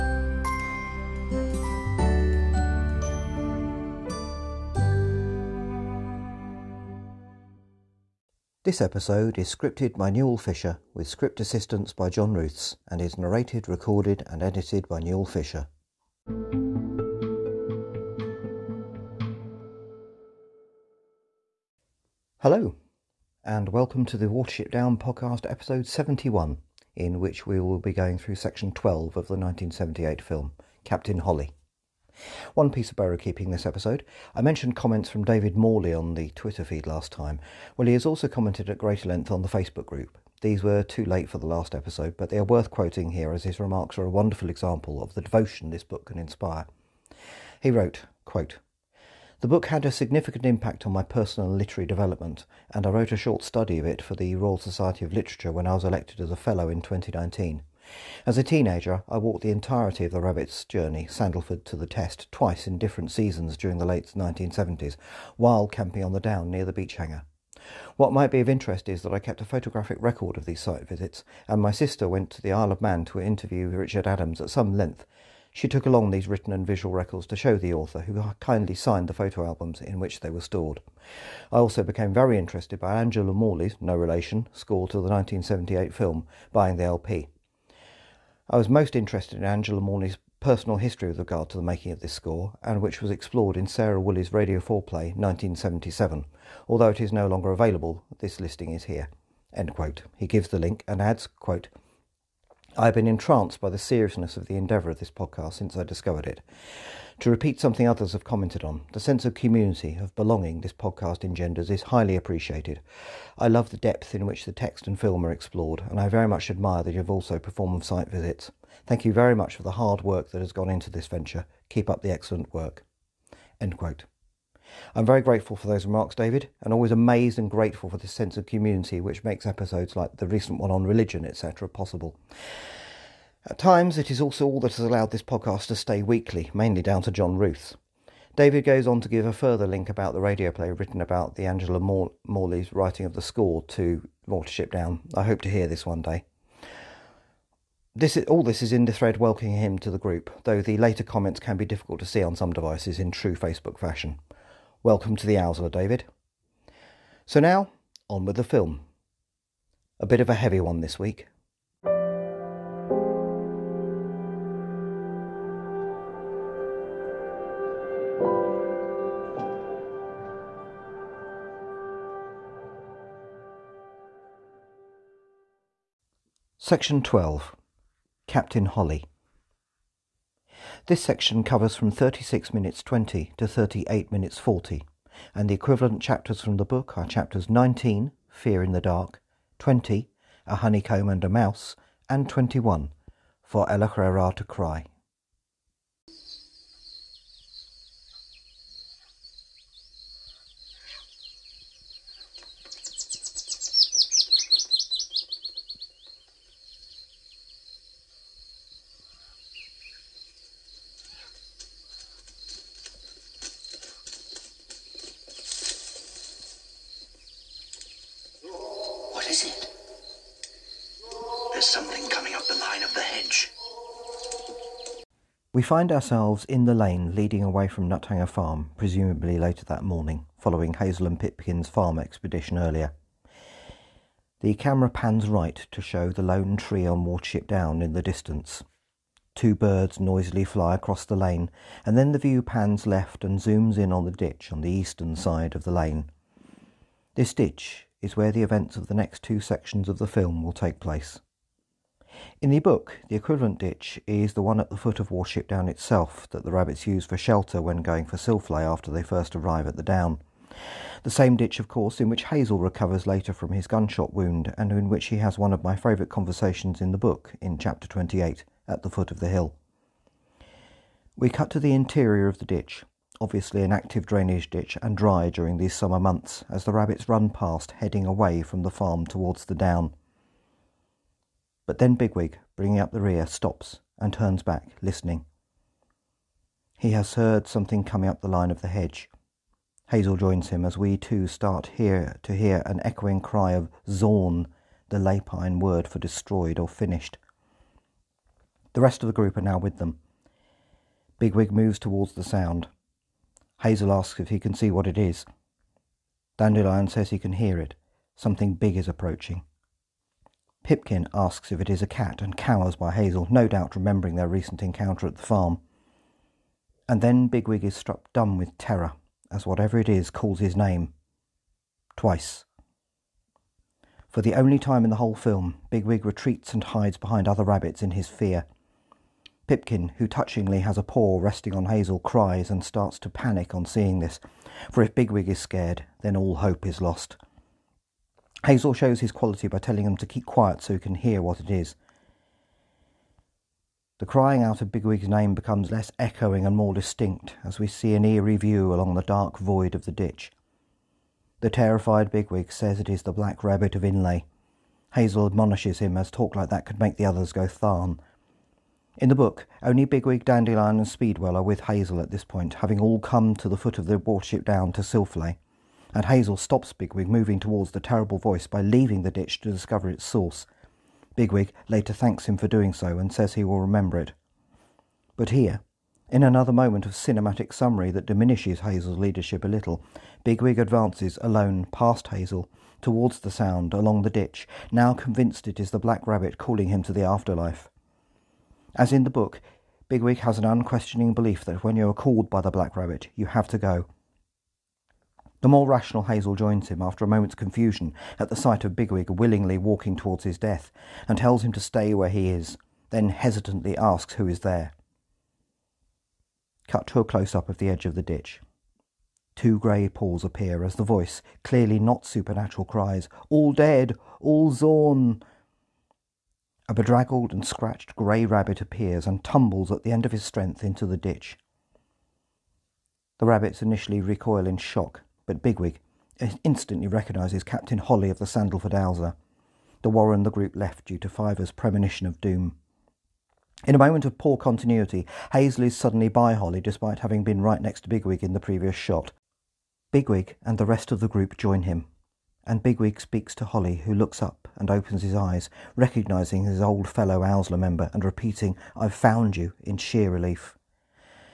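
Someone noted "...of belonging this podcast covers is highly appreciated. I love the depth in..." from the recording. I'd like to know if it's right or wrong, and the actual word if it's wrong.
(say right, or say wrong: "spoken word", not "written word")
wrong: "engenders", not "covers".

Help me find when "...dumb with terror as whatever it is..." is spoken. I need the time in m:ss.
5:18.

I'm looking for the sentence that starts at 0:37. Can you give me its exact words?
Well, he has also commented at greater length on the Facebook group.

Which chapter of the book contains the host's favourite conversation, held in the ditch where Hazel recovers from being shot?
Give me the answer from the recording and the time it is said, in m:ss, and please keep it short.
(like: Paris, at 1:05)
Chapter 28, at 4:27.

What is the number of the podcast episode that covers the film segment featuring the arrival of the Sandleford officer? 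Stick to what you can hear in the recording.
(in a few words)
71.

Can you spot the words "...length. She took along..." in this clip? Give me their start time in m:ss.
1:14.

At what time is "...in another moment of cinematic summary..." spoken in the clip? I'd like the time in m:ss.
6:16.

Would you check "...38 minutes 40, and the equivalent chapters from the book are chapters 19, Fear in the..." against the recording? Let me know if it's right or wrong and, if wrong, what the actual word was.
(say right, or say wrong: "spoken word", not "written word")
right.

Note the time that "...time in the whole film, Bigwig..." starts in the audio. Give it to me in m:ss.
5:24.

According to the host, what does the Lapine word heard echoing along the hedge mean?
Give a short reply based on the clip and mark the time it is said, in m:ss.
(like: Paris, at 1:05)
destroyed or finished, at 4:55.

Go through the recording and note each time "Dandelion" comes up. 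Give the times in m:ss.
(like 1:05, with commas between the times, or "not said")
5:06, 6:00.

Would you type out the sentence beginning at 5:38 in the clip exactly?
Hazel shows his quality by telling him to keep quiet so he can hear what it is.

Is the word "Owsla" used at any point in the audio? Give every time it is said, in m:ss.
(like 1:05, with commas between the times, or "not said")
2:35, 7:08, 7:27.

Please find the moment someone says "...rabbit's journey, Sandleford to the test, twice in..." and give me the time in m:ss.
1:00.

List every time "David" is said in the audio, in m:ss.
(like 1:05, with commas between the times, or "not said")
0:35, 2:06, 2:18, 2:35.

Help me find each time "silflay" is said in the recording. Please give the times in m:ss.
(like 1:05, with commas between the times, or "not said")
4:18, 6:04.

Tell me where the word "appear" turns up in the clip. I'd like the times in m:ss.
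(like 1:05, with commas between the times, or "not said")
6:50, 6:58.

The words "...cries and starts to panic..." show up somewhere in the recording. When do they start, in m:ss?
5:31.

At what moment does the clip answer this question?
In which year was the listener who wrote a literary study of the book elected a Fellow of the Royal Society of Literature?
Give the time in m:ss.
0:56.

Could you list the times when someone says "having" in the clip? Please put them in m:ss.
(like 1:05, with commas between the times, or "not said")
6:02, 7:16.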